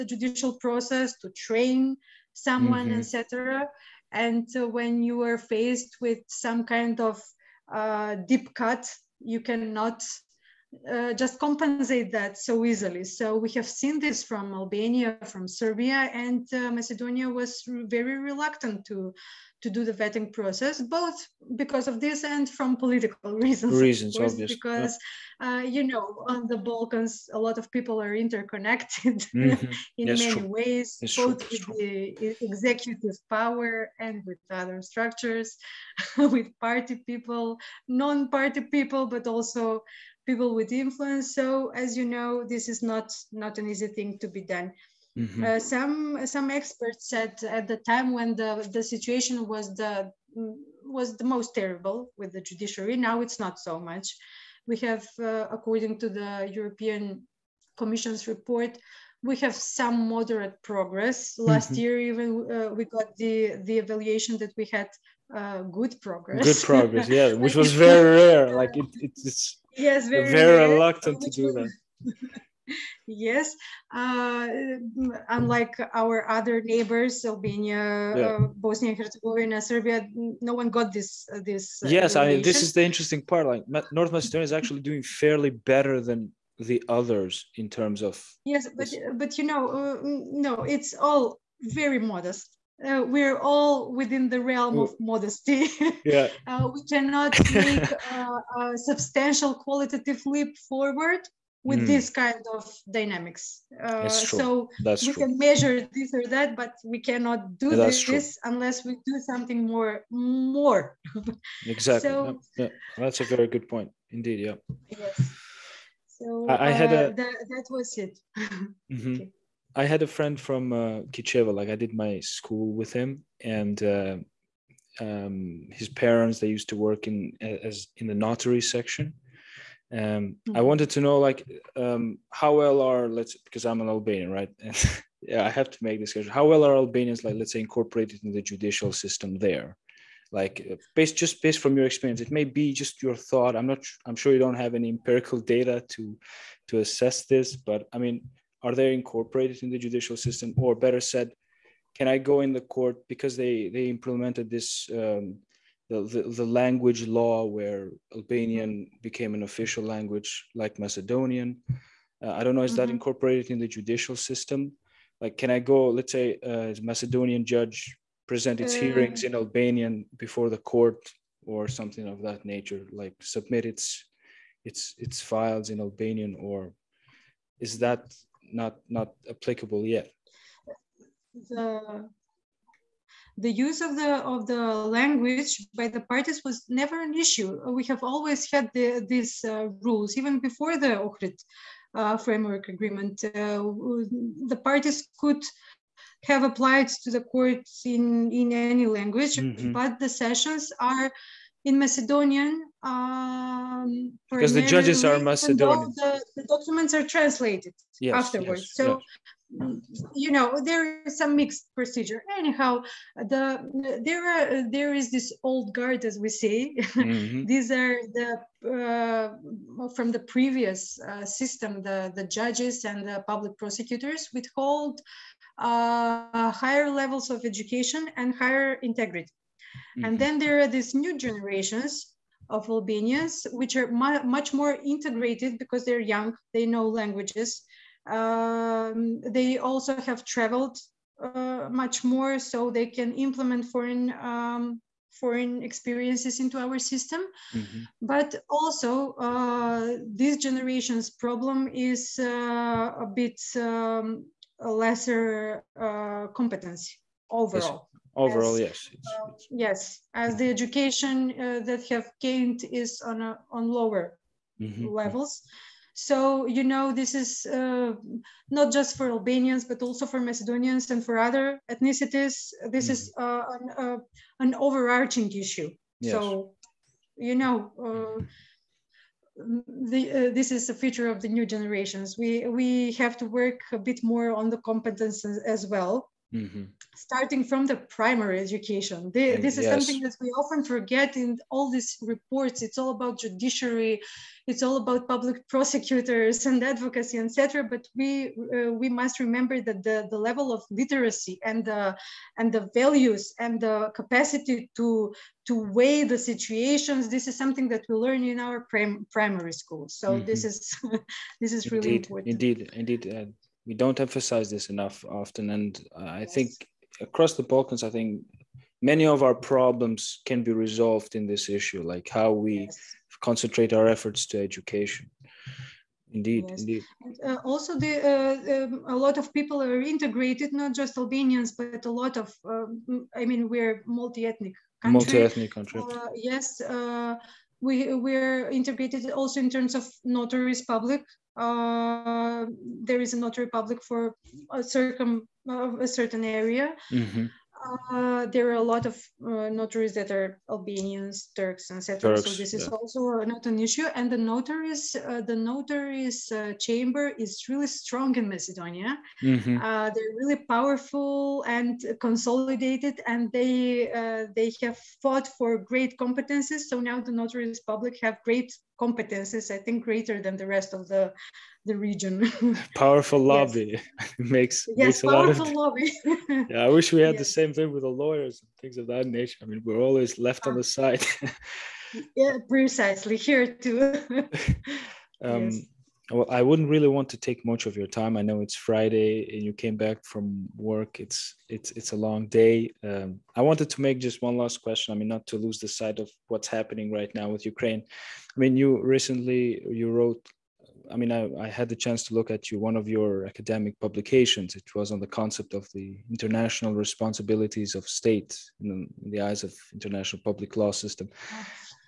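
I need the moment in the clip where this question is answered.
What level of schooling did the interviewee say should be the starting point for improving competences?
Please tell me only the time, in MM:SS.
04:47.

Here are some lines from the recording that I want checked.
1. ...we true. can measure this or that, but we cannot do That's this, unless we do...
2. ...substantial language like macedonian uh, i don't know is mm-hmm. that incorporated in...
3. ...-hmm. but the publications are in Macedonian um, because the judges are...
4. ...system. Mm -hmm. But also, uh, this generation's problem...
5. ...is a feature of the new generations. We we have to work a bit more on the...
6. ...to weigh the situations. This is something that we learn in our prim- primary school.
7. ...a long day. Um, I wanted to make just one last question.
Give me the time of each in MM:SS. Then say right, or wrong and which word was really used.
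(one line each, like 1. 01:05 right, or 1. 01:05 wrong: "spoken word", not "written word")
1. 01:45 right
2. 02:39 wrong: "official", not "substantial"
3. 03:19 wrong: "sessions", not "publications"
4. 04:06 right
5. 04:40 right
6. 05:05 right
7. 06:31 right.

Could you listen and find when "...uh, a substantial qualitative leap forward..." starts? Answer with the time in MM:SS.
01:38.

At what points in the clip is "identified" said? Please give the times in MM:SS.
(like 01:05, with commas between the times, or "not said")
not said.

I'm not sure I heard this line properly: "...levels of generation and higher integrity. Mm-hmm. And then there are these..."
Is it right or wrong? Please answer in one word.
wrong.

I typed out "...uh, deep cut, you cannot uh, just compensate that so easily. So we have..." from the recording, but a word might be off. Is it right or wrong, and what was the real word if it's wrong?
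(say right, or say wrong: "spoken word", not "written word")
right.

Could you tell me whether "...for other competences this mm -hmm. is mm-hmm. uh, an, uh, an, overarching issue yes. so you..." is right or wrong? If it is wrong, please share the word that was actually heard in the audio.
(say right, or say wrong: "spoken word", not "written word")
wrong: "ethnicities", not "competences".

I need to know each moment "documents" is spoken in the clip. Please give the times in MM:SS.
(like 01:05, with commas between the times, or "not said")
03:26.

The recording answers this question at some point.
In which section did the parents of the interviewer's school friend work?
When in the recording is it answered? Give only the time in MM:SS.
02:08.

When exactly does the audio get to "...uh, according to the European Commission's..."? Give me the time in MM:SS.
00:55.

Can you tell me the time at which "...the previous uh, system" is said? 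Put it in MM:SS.
03:40.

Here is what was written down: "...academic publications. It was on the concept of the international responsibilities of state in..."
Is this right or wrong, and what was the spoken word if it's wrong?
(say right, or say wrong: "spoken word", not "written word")
right.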